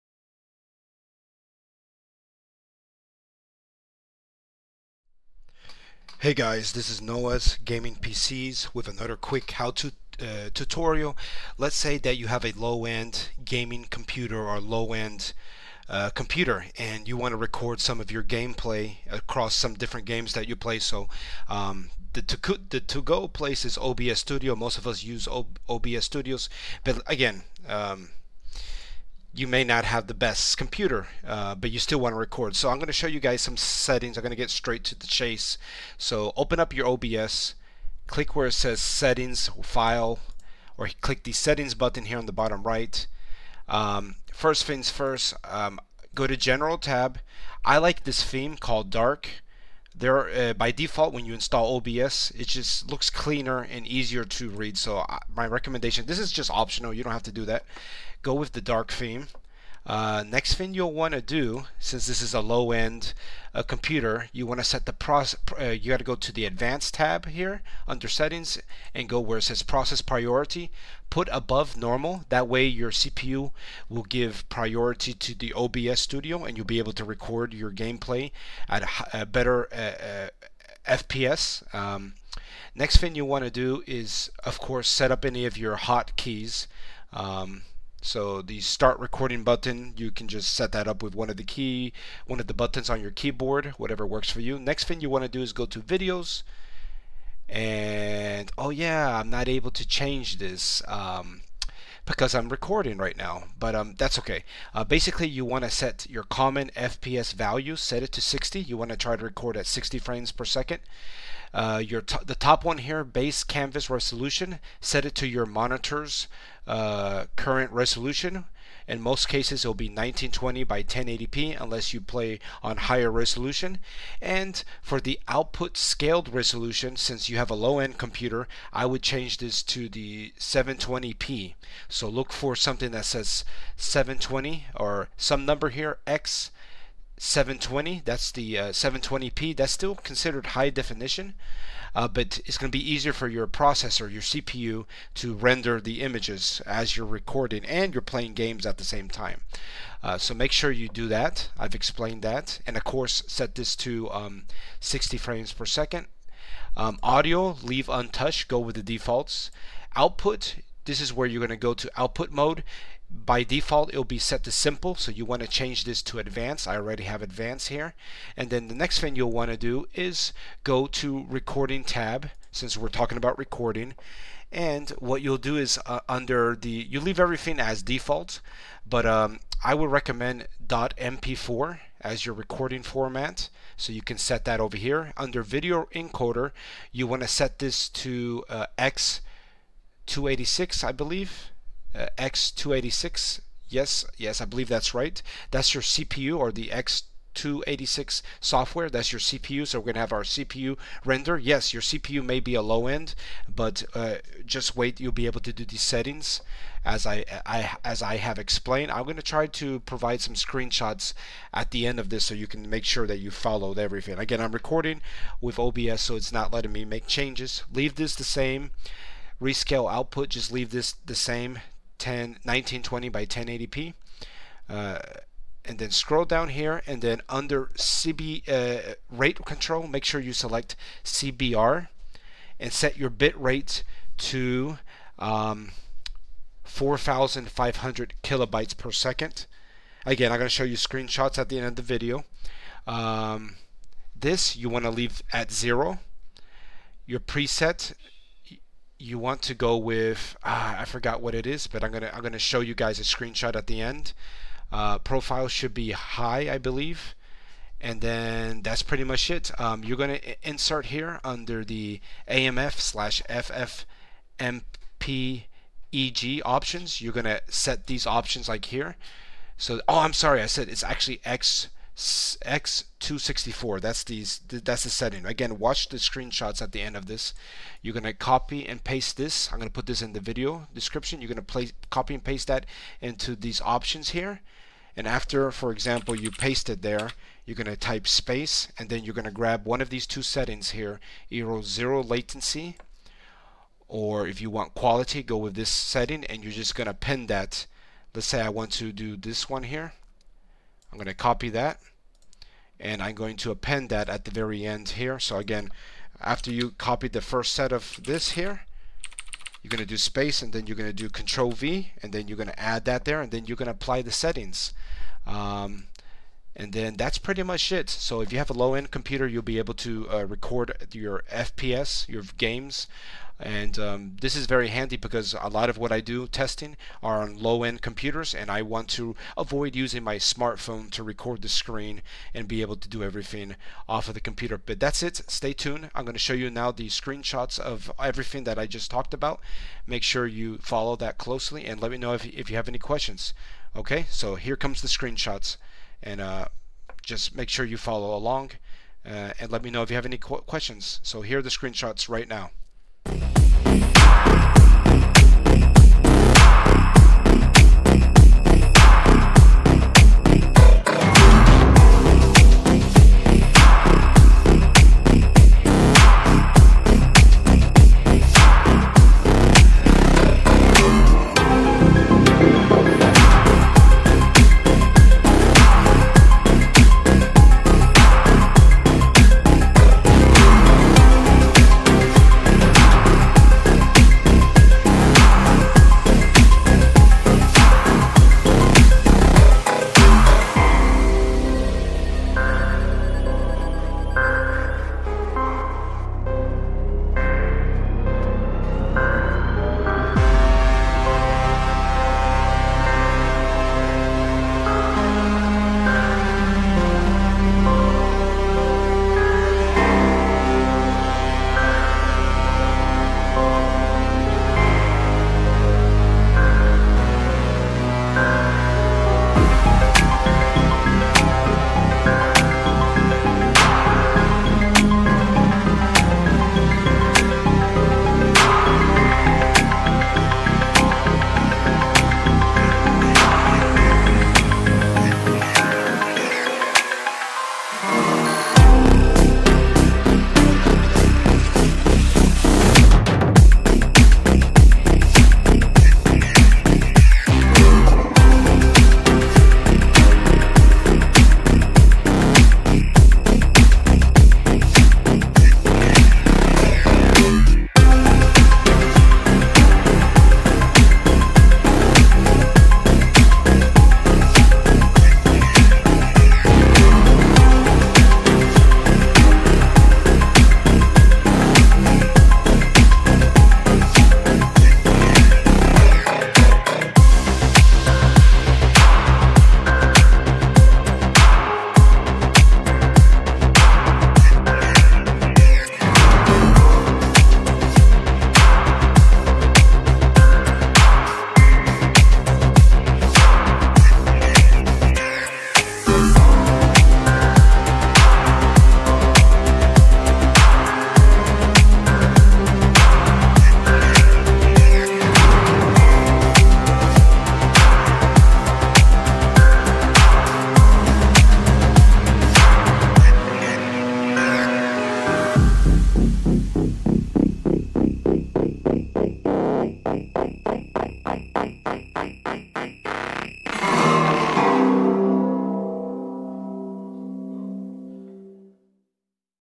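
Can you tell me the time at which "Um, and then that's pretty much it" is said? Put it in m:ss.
5:15.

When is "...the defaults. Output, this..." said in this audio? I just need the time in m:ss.
2:38.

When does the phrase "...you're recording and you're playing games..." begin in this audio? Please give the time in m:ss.
2:26.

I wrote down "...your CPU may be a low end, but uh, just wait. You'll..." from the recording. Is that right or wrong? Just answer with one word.
right.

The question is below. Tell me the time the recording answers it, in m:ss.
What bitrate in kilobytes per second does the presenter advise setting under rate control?
3:56.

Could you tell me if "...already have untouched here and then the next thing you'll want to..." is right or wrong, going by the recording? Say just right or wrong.
wrong.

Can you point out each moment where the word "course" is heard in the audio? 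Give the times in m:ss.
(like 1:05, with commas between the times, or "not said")
1:24, 2:32.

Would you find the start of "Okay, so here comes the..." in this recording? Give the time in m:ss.
5:43.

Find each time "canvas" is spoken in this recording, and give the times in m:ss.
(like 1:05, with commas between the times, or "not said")
1:53.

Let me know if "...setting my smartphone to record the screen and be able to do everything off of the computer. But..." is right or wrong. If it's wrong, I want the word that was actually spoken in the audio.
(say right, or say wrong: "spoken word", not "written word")
wrong: "using", not "setting".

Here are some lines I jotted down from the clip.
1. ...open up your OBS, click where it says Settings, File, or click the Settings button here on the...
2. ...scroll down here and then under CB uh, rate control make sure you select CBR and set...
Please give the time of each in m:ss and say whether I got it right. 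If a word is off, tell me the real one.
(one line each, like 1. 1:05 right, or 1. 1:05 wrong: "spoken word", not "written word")
1. 0:36 right
2. 3:45 right.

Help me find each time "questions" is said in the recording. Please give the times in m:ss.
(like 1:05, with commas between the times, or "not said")
5:42, 5:50.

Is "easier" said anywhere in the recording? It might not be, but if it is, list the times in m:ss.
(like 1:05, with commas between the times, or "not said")
0:53, 2:22.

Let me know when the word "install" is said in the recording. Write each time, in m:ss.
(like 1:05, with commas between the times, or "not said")
0:51.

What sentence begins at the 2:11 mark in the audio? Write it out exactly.
So look for something that says 720 or some number here, X 720.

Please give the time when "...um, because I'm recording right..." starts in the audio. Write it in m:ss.
1:40.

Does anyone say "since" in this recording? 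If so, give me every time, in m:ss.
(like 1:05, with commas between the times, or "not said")
1:01, 2:06, 2:52.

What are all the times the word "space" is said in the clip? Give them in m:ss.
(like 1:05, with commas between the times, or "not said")
4:48, 5:09.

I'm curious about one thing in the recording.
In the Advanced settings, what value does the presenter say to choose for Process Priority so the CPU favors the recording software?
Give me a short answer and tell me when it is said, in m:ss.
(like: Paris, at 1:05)
Above Normal, at 1:11.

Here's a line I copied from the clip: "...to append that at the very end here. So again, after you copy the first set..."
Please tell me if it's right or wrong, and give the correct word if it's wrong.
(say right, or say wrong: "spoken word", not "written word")
right.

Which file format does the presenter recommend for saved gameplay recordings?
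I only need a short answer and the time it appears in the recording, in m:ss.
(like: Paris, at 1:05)
MP4, at 3:00.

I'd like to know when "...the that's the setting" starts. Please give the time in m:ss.
4:34.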